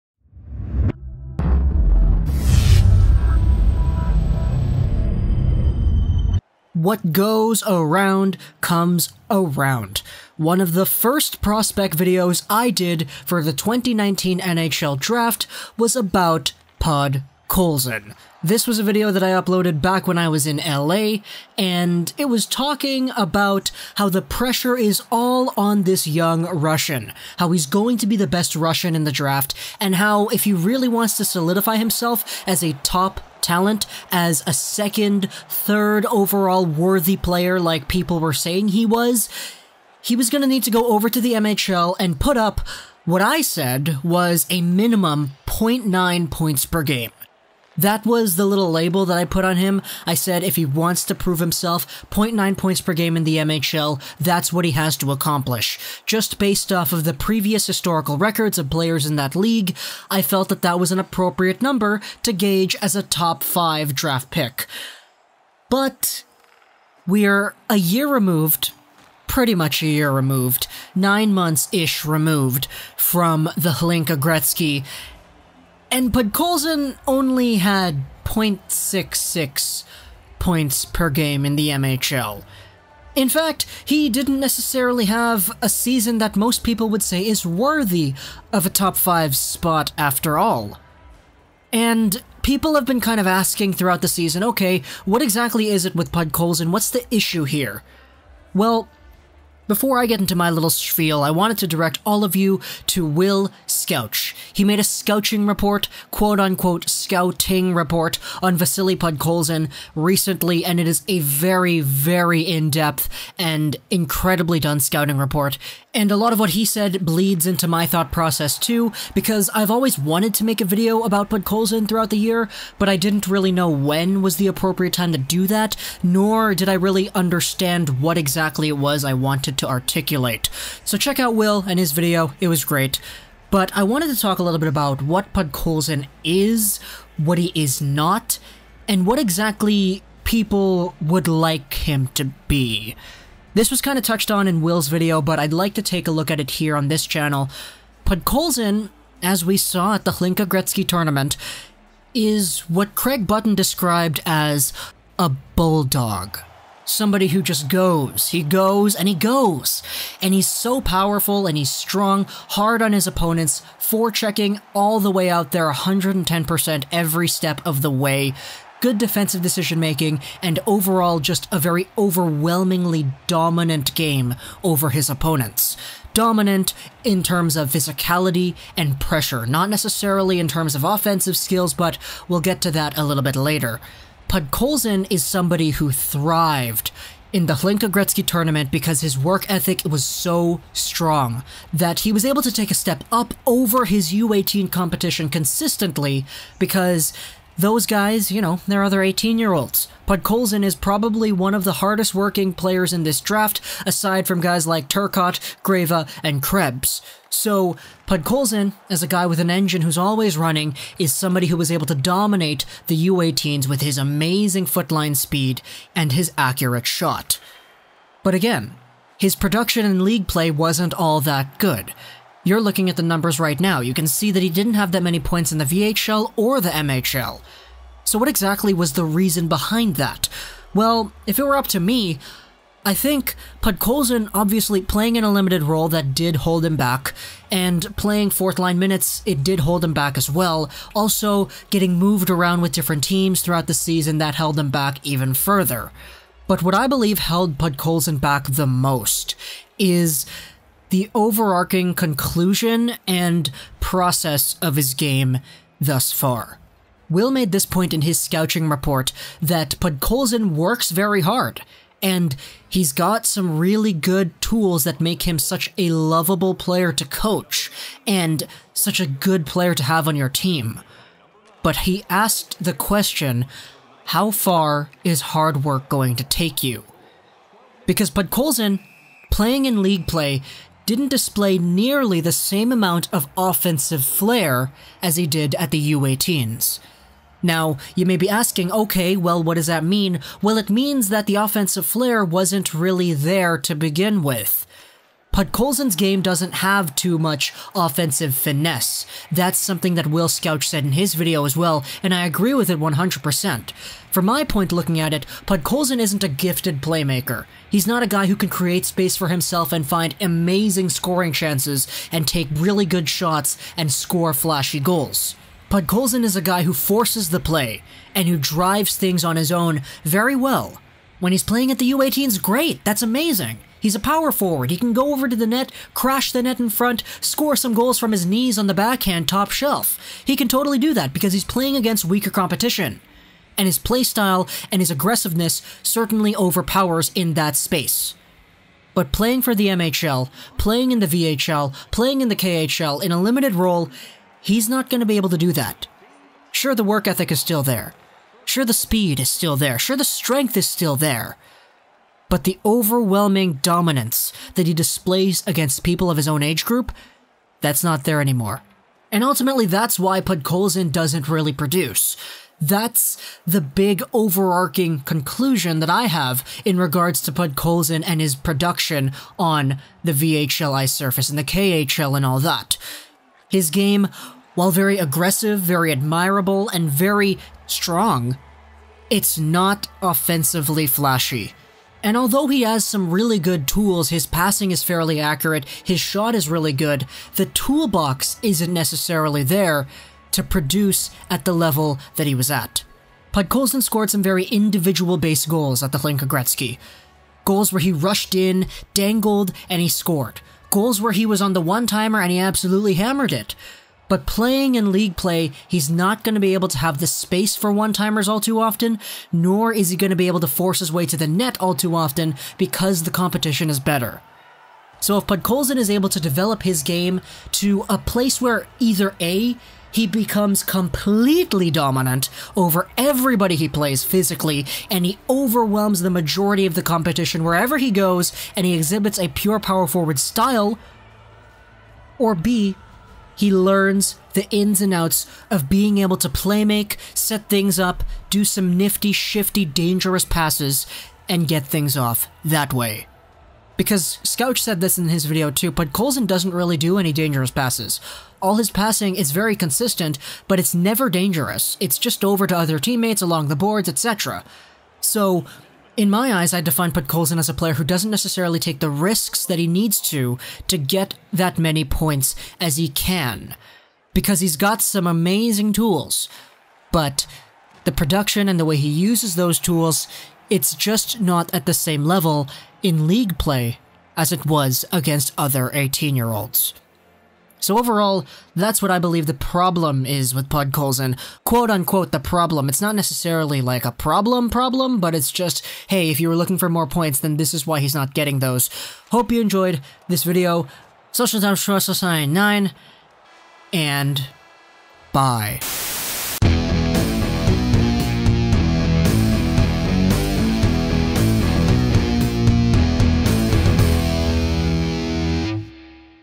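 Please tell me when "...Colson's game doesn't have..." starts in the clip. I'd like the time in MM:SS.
04:55.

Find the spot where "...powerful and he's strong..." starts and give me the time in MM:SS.
02:40.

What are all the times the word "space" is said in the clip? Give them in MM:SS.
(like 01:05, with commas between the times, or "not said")
05:08, 05:37, 06:47.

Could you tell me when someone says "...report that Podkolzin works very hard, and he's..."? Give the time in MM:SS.
04:18.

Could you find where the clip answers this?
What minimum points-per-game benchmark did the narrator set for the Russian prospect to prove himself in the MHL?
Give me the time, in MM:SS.
00:44.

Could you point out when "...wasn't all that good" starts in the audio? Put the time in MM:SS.
03:40.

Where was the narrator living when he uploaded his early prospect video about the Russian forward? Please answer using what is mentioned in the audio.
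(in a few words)
LA.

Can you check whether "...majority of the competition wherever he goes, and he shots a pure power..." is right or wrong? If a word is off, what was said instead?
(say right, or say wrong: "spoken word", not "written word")
wrong: "exhibits", not "shots".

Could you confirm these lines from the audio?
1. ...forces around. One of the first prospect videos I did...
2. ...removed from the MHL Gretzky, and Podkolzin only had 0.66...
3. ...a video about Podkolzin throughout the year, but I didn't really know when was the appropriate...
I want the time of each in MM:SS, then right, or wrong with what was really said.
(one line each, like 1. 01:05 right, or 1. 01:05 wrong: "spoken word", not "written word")
1. 00:08 wrong: "comes", not "forces"
2. 01:12 wrong: "Hlinka", not "MHL"
3. 02:00 right.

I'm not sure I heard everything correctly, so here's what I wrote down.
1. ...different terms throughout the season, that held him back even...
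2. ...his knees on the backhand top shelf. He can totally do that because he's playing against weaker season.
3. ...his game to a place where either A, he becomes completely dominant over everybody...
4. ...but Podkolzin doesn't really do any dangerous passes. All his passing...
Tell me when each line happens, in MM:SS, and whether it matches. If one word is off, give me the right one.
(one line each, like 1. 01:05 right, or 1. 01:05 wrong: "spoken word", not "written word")
1. 04:02 wrong: "teams", not "terms"
2. 05:28 wrong: "competition", not "season"
3. 06:56 right
4. 07:25 wrong: "Colson", not "Podkolzin".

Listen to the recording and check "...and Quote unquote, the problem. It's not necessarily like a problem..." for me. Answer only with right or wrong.
right.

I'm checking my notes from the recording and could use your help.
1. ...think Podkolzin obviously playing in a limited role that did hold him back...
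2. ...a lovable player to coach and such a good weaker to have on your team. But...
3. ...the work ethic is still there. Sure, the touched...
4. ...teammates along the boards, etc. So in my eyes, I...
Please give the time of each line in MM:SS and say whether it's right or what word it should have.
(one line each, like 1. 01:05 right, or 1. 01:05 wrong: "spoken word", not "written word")
1. 03:52 right
2. 04:25 wrong: "player", not "weaker"
3. 05:46 wrong: "speed", not "touched"
4. 07:32 right.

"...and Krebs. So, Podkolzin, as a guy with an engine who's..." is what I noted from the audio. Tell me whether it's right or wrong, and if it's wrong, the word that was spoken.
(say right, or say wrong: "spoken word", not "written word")
right.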